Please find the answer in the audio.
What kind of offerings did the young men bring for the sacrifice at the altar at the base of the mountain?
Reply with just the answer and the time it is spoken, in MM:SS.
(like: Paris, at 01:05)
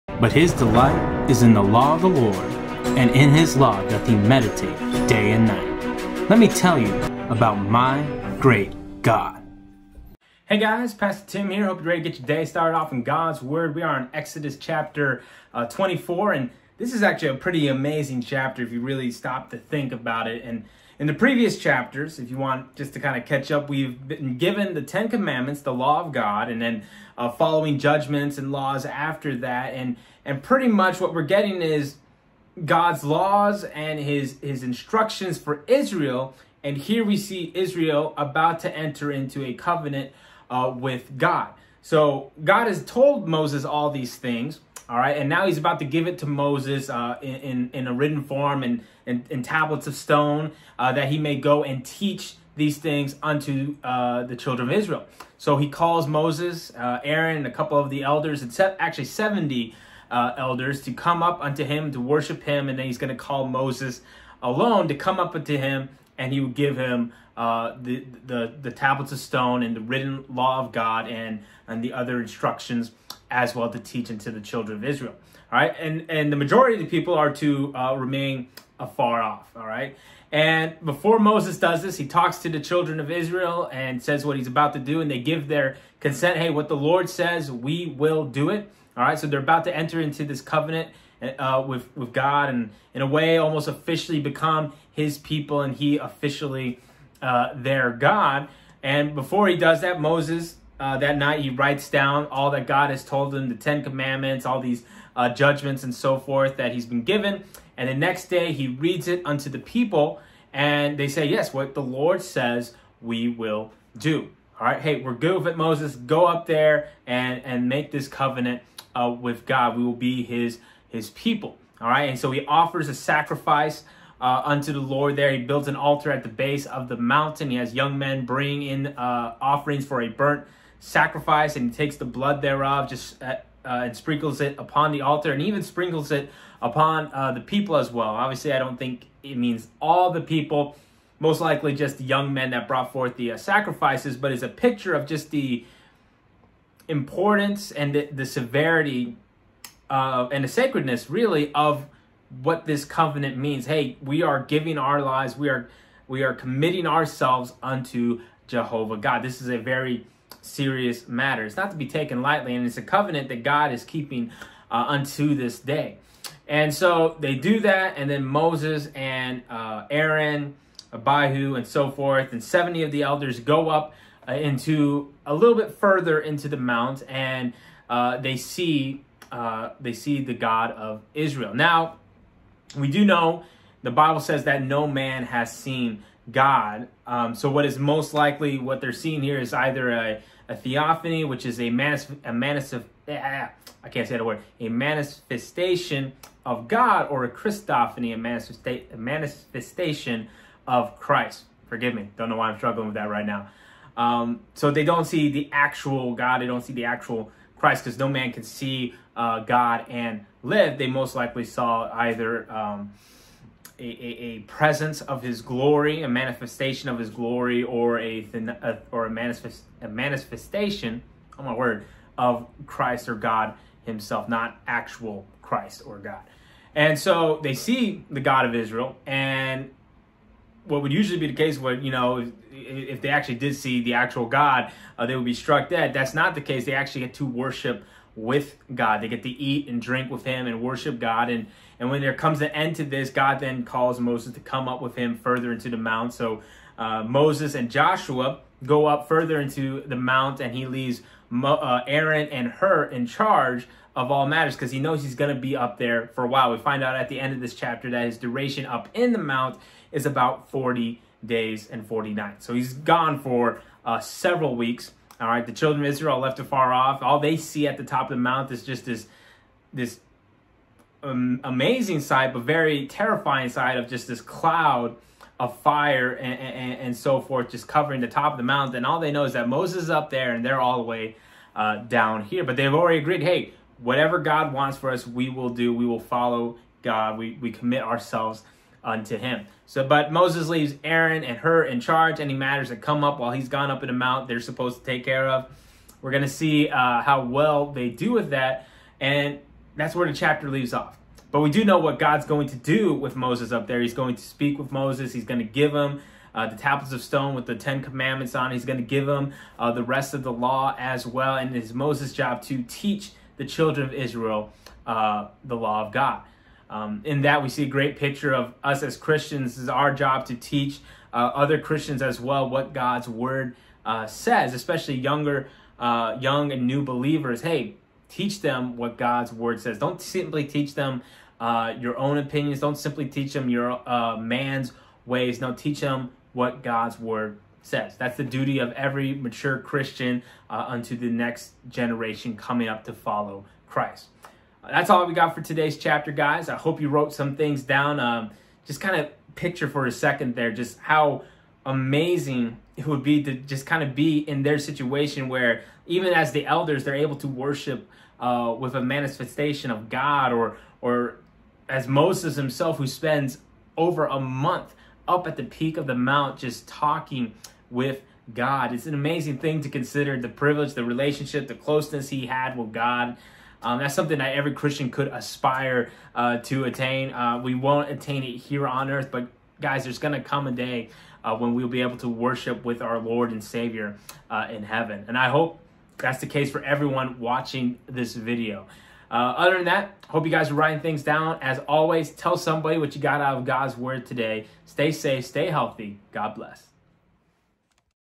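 burnt sacrifice, at 02:10.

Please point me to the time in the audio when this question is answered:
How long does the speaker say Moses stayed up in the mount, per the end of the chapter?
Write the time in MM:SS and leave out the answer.
04:20.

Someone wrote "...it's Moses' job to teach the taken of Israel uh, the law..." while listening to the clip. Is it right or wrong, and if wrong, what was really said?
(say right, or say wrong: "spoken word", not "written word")
wrong: "children", not "taken".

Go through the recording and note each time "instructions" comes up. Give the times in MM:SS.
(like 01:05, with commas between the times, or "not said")
00:34, 01:12.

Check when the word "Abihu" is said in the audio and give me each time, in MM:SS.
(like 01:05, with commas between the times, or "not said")
02:50.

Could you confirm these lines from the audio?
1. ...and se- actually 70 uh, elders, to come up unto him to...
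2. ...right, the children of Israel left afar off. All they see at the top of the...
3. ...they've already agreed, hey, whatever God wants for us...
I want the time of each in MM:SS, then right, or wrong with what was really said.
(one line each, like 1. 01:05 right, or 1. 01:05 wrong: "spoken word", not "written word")
1. 00:58 right
2. 04:25 right
3. 04:42 right.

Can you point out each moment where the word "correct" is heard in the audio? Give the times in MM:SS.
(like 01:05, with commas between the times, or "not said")
not said.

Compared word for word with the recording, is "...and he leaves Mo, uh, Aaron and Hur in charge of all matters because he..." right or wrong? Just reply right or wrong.
right.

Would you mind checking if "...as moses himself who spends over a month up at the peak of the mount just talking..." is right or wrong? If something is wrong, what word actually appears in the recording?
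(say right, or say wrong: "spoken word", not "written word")
right.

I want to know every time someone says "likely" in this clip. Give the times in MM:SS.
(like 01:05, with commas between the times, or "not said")
02:21, 03:08, 03:31.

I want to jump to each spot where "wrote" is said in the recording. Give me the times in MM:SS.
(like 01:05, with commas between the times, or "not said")
05:46.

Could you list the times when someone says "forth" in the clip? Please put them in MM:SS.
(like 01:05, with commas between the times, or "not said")
01:46, 02:22, 02:51, 04:37.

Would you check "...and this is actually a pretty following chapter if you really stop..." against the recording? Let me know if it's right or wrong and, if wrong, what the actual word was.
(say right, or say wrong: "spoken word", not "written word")
wrong: "amazing", not "following".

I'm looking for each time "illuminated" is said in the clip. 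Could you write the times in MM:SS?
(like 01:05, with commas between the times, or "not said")
not said.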